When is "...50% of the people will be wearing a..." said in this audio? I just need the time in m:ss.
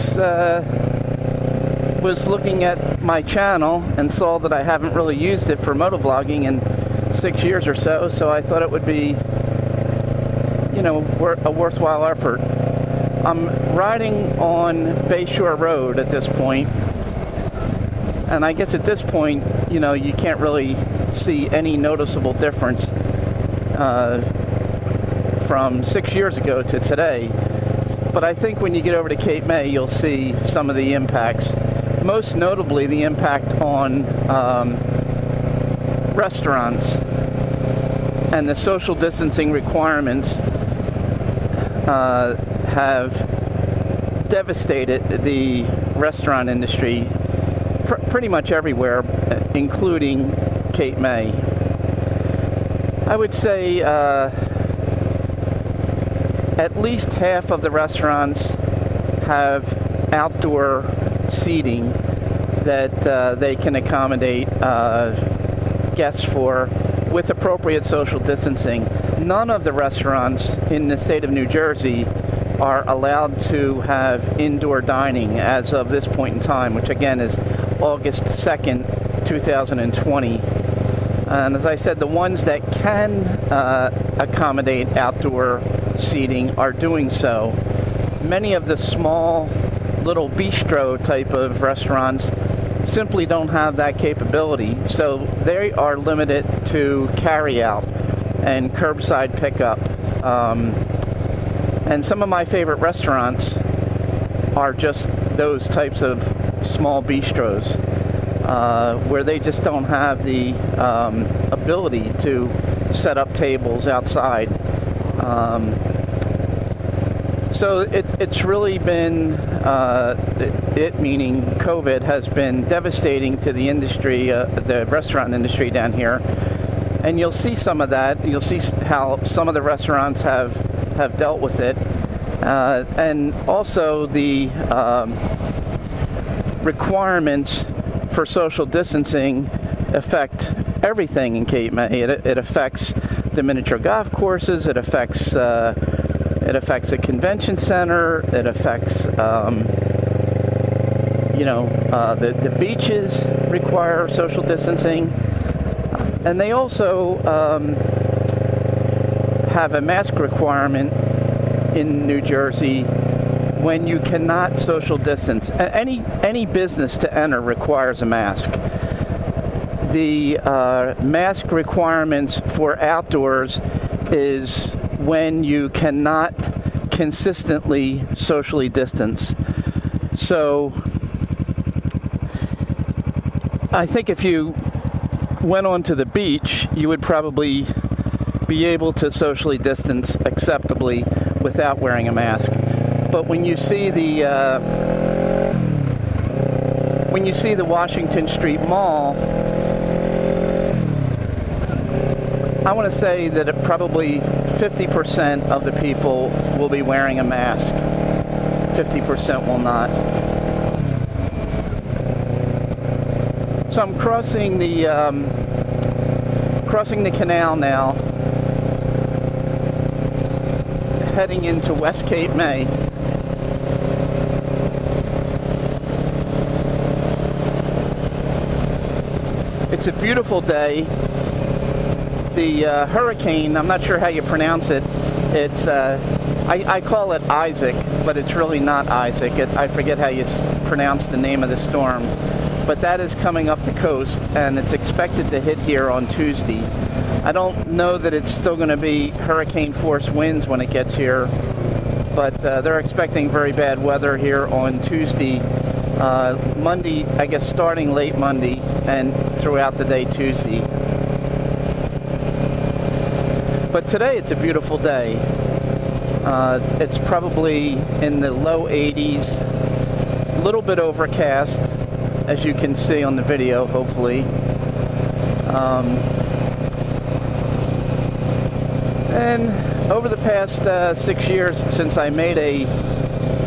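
3:24.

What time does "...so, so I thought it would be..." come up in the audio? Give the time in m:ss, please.
0:07.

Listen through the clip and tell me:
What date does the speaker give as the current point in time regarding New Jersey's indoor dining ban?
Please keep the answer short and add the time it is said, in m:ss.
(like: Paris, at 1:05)
August 2nd, 2020, at 1:17.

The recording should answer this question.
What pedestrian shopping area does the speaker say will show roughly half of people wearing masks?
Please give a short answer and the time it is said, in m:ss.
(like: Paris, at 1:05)
Washington Street Mall, at 3:17.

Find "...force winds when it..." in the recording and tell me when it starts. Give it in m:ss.
4:09.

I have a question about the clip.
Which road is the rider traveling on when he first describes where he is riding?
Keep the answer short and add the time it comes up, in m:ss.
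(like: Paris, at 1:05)
Bayshore Road, at 0:15.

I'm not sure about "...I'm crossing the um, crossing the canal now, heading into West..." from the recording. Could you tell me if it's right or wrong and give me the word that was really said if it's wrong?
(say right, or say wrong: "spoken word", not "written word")
right.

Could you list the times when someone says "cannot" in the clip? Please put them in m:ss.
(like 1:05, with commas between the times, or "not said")
2:43, 2:55.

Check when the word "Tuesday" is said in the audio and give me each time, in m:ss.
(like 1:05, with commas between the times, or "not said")
4:06, 4:14, 4:20.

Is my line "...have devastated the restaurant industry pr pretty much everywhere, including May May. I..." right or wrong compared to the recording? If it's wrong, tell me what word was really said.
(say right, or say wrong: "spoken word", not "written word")
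wrong: "Cape", not "May".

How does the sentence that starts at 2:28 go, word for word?
It affects, um, you know, uh, the, the beaches require social distancing.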